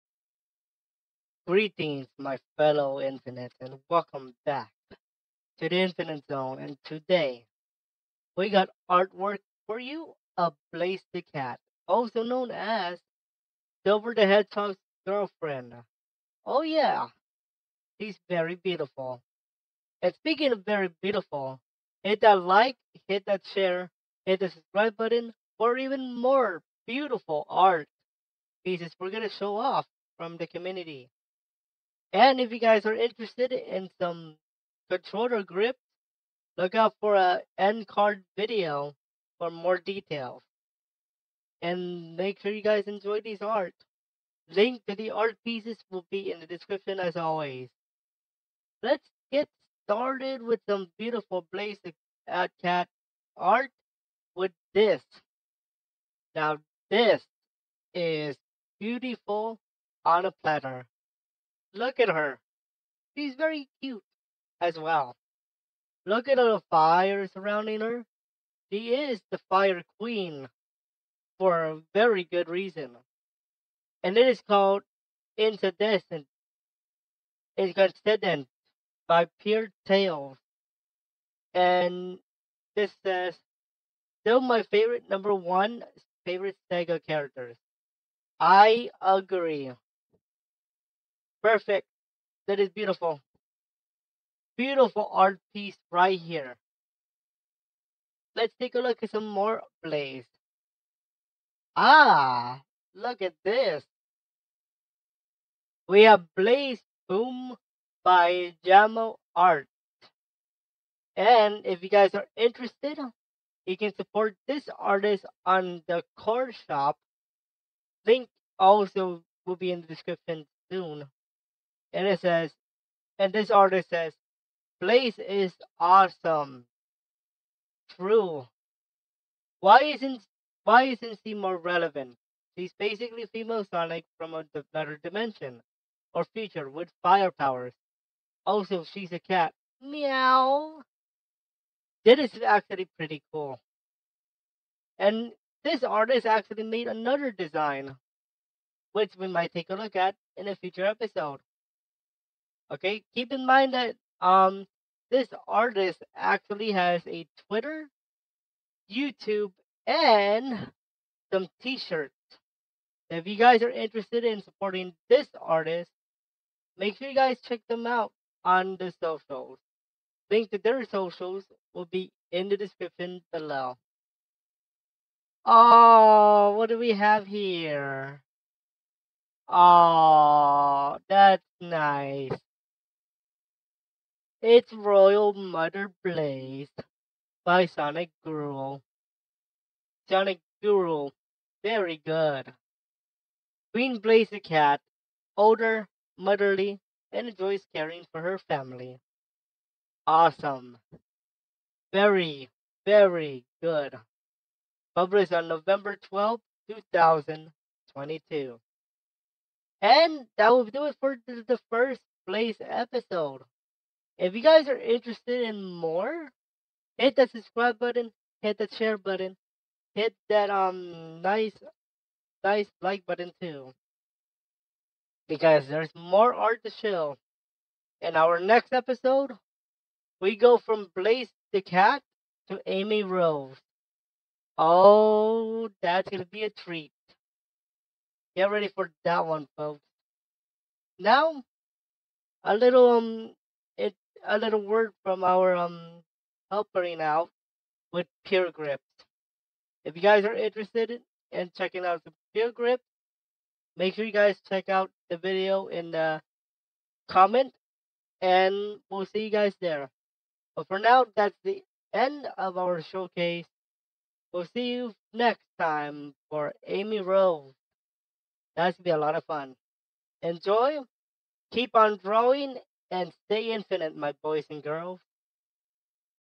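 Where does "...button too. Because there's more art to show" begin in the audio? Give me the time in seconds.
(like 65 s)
223 s.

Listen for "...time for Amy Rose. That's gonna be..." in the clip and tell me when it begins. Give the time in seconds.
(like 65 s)
265 s.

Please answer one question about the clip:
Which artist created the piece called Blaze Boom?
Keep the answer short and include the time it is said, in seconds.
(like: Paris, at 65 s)
Jamo Art, at 108 s.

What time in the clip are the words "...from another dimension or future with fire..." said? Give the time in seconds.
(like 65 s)
134 s.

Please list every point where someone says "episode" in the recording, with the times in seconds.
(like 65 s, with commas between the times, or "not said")
150 s, 212 s, 228 s.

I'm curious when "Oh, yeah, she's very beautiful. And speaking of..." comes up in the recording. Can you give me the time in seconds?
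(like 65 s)
16 s.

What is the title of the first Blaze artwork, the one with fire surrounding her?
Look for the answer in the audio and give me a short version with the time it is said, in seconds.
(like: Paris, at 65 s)
Incandescent, at 74 s.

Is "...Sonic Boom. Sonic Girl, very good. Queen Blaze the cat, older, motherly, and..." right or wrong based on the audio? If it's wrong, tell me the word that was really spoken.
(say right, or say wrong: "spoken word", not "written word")
wrong: "Girl", not "Boom".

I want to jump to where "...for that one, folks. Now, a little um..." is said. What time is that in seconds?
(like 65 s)
238 s.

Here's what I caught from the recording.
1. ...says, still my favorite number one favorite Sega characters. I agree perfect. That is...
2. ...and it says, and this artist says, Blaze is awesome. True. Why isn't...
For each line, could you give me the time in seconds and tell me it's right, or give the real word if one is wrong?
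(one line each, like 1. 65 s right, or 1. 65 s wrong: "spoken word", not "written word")
1. 83 s right
2. 121 s right.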